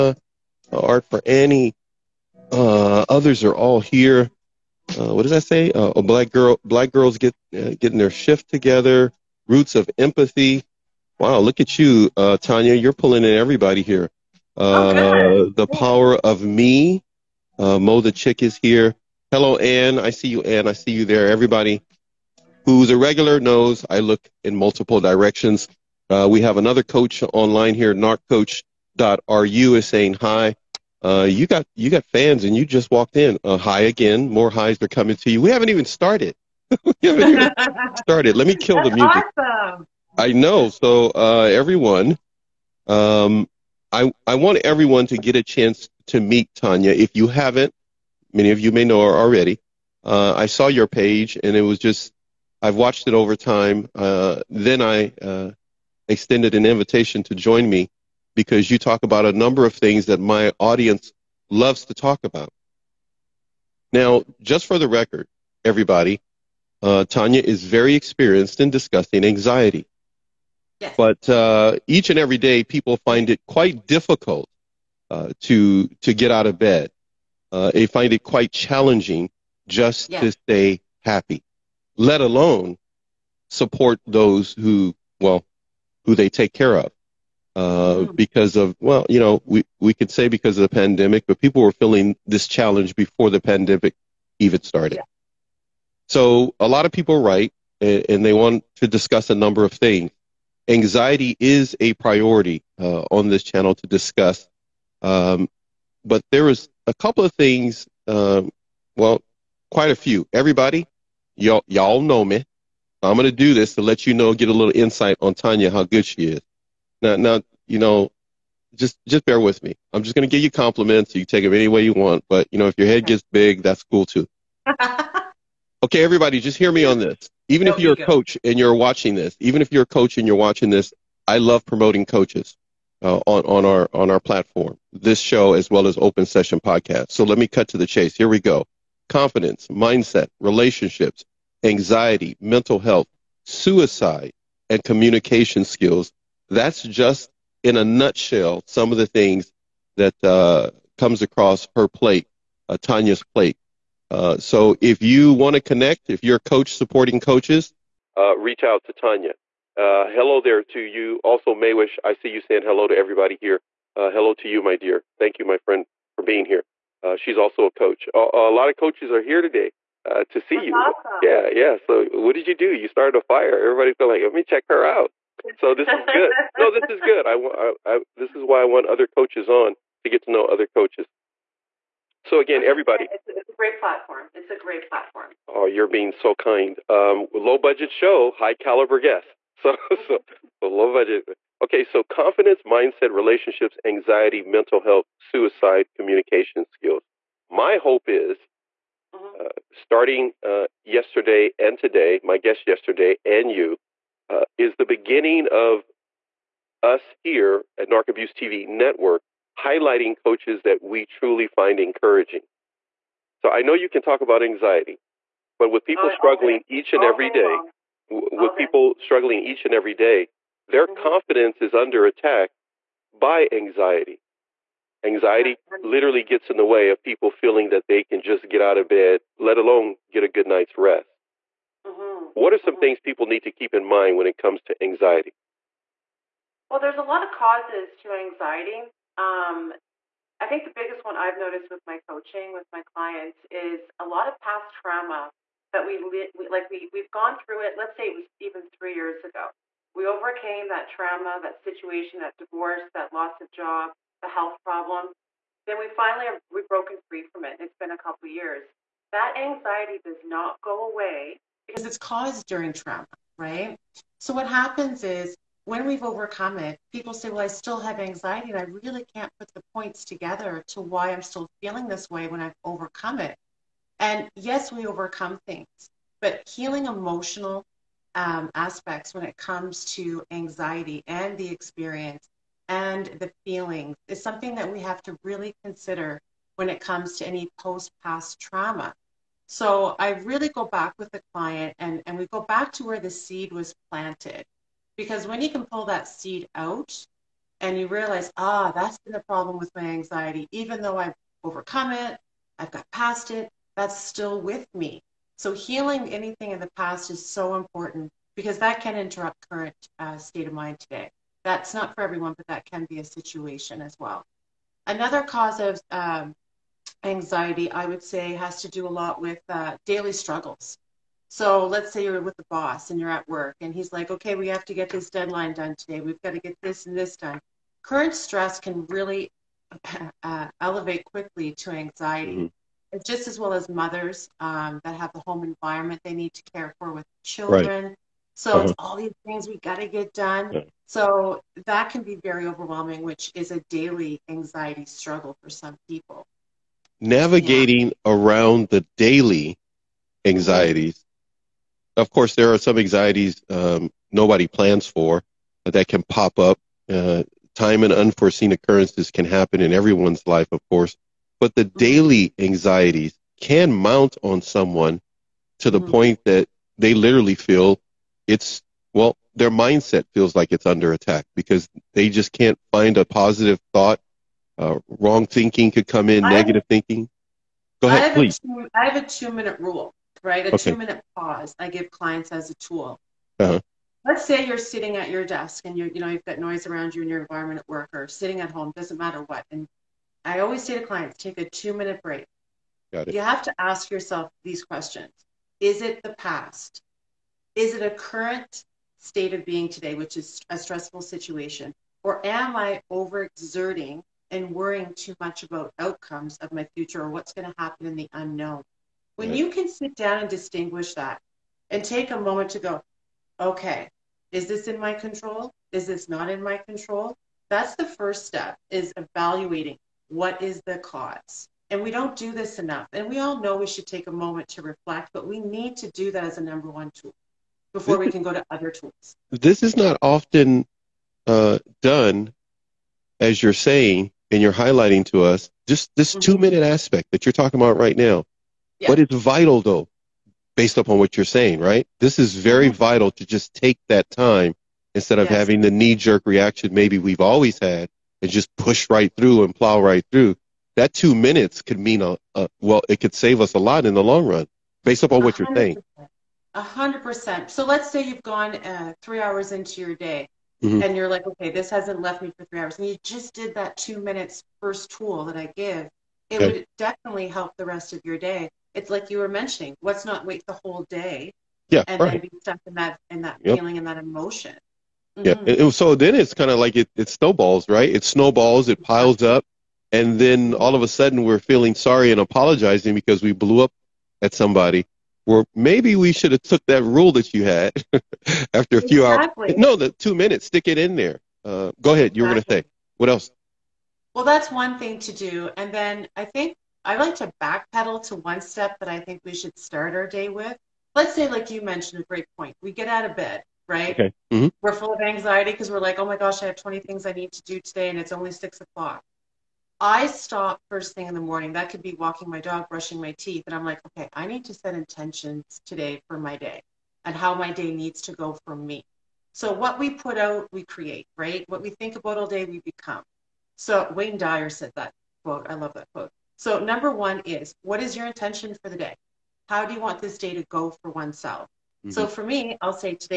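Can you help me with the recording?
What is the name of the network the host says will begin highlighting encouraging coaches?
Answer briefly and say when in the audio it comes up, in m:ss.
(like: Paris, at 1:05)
Narc Abuse TV Network, at 3:27.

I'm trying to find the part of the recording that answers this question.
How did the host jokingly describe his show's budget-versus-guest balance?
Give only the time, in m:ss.
3:07.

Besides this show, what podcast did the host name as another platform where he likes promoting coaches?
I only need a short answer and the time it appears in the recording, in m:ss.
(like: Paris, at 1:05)
Open Session, at 2:15.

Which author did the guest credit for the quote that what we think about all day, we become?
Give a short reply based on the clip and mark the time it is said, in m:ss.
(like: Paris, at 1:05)
Wayne Dyer, at 8:43.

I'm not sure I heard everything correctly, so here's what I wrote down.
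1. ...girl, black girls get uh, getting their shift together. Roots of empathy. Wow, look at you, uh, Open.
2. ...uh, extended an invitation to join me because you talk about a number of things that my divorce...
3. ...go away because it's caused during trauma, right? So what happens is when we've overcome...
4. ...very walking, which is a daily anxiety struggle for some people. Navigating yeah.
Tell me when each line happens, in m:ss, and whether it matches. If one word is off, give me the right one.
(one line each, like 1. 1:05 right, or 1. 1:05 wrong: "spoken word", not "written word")
1. 0:06 wrong: "Tanya", not "Open"
2. 0:55 wrong: "audience", not "divorce"
3. 4:20 right
4. 5:42 wrong: "overwhelming", not "walking".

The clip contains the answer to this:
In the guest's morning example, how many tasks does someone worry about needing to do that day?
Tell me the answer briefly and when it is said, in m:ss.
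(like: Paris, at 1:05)
20, at 8:26.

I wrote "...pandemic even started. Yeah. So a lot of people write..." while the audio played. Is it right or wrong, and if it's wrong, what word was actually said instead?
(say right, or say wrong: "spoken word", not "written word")
right.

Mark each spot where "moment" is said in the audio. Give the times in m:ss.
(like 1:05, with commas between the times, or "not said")
6:52, 7:04.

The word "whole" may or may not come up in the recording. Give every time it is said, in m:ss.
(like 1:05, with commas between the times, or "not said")
7:50.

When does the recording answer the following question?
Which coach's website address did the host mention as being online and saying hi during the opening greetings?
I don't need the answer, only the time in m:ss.
0:27.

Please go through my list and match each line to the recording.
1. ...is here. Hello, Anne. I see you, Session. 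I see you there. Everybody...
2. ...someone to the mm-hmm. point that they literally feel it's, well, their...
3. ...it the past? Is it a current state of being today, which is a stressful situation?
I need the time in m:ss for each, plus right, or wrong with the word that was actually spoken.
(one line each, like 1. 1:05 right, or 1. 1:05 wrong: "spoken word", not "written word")
1. 0:18 wrong: "Anne", not "Session"
2. 6:04 right
3. 6:35 right.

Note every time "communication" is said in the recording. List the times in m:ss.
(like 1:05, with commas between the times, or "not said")
2:24, 3:15.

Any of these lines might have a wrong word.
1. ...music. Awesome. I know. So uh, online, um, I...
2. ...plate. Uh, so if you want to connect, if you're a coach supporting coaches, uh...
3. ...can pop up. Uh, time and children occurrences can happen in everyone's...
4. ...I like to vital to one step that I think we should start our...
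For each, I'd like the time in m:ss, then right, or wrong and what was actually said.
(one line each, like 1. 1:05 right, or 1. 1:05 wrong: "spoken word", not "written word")
1. 0:38 wrong: "everyone", not "online"
2. 2:33 right
3. 5:55 wrong: "unforeseen", not "children"
4. 8:16 wrong: "backpedal", not "vital".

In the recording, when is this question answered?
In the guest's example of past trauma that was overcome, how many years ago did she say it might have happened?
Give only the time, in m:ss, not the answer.
4:08.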